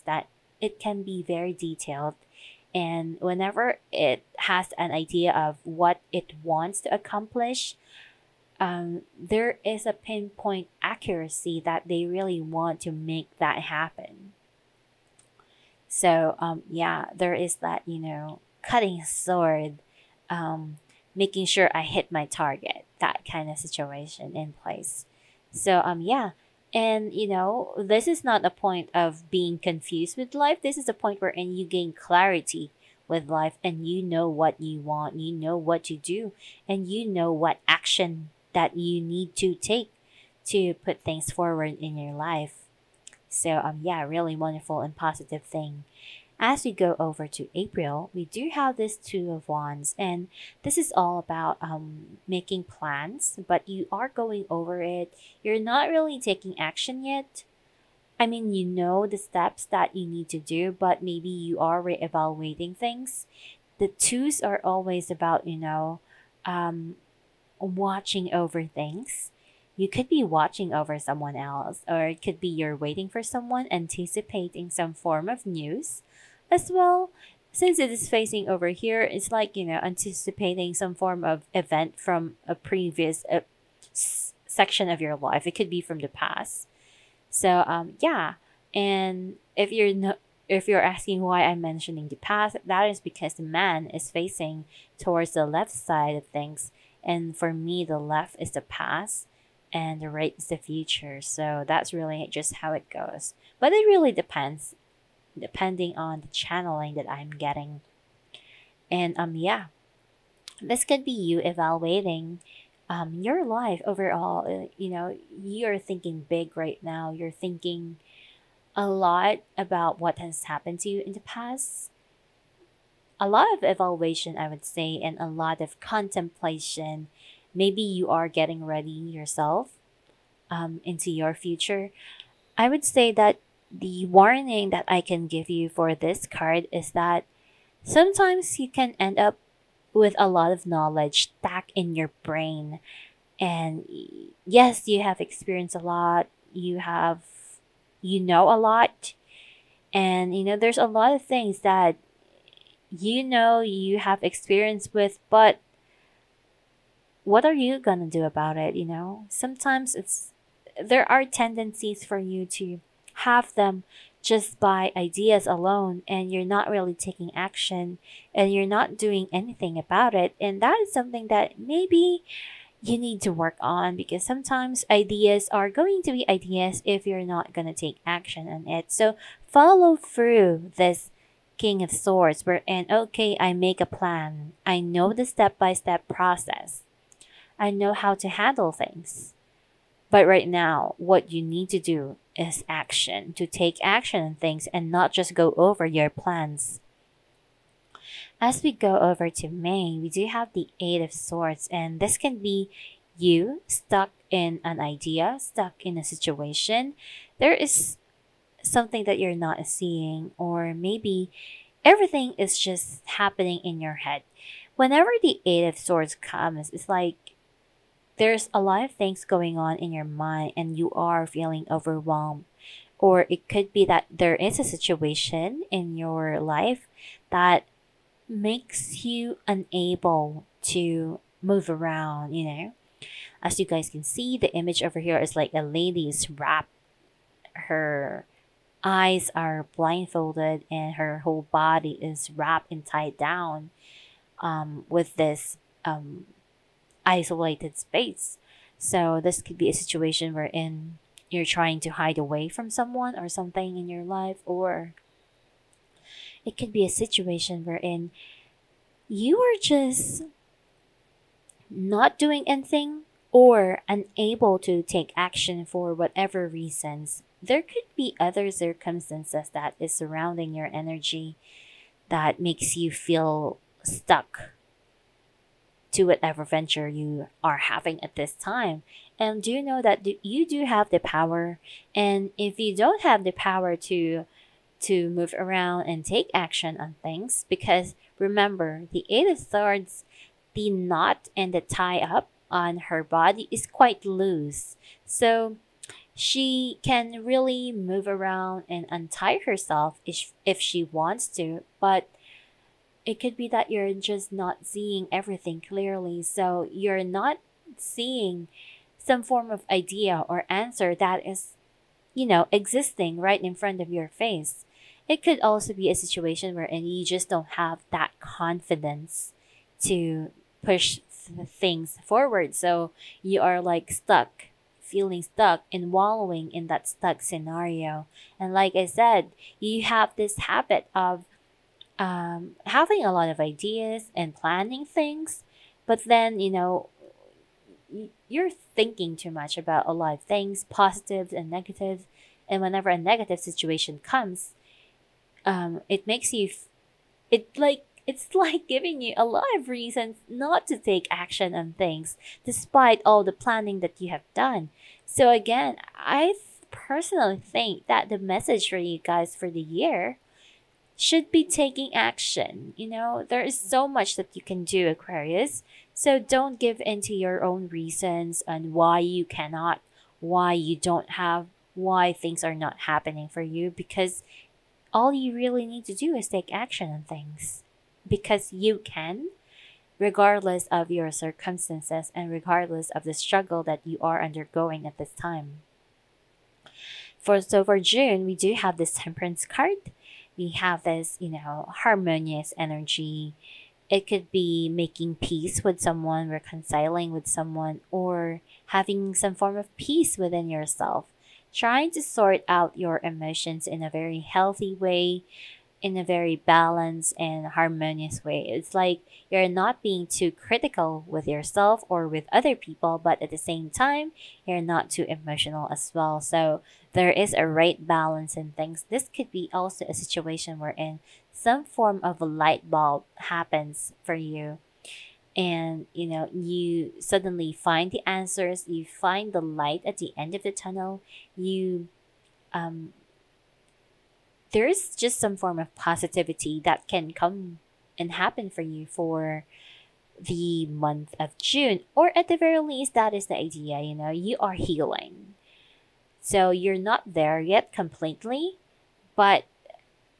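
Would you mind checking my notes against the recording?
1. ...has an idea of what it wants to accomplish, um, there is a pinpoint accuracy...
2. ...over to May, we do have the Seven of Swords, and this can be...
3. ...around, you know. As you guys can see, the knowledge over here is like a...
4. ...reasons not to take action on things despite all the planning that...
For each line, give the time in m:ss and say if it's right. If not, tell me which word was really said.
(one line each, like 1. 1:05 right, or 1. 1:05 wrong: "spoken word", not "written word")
1. 0:04 right
2. 3:18 wrong: "Eight", not "Seven"
3. 3:51 wrong: "image", not "knowledge"
4. 5:49 right.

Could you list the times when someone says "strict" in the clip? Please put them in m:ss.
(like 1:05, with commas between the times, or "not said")
not said.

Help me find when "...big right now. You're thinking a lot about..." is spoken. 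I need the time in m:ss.
1:56.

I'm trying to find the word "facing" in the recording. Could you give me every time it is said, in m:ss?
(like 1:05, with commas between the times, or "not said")
1:18, 1:34.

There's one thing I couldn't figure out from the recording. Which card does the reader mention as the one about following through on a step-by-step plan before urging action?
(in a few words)
King of Swords.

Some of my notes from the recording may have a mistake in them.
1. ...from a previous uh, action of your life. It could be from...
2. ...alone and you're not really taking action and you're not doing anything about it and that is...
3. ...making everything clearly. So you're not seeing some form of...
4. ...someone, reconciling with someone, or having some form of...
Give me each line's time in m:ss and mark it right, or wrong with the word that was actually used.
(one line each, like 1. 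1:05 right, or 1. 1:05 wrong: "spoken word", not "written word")
1. 1:21 wrong: "section", not "action"
2. 2:45 right
3. 5:04 wrong: "seeing", not "making"
4. 6:35 right.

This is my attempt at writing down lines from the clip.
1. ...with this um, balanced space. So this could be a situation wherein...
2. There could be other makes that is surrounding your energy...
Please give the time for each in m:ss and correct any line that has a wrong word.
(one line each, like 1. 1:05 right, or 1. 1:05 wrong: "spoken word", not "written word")
1. 4:04 wrong: "isolated", not "balanced"
2. 4:27 wrong: "circumstances", not "makes".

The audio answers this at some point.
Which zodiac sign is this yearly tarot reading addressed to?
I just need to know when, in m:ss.
6:04.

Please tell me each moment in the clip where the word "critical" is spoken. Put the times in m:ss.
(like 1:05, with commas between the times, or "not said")
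6:50.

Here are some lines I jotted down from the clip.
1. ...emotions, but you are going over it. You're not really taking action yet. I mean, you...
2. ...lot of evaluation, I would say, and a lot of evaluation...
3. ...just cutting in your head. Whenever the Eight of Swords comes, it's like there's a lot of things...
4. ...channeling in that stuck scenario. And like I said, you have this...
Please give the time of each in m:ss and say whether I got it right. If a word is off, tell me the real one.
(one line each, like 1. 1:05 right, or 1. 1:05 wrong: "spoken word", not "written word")
1. 0:52 wrong: "plans", not "emotions"
2. 2:03 wrong: "contemplation", not "evaluation"
3. 3:32 wrong: "happening", not "cutting"
4. 5:25 wrong: "wallowing", not "channeling".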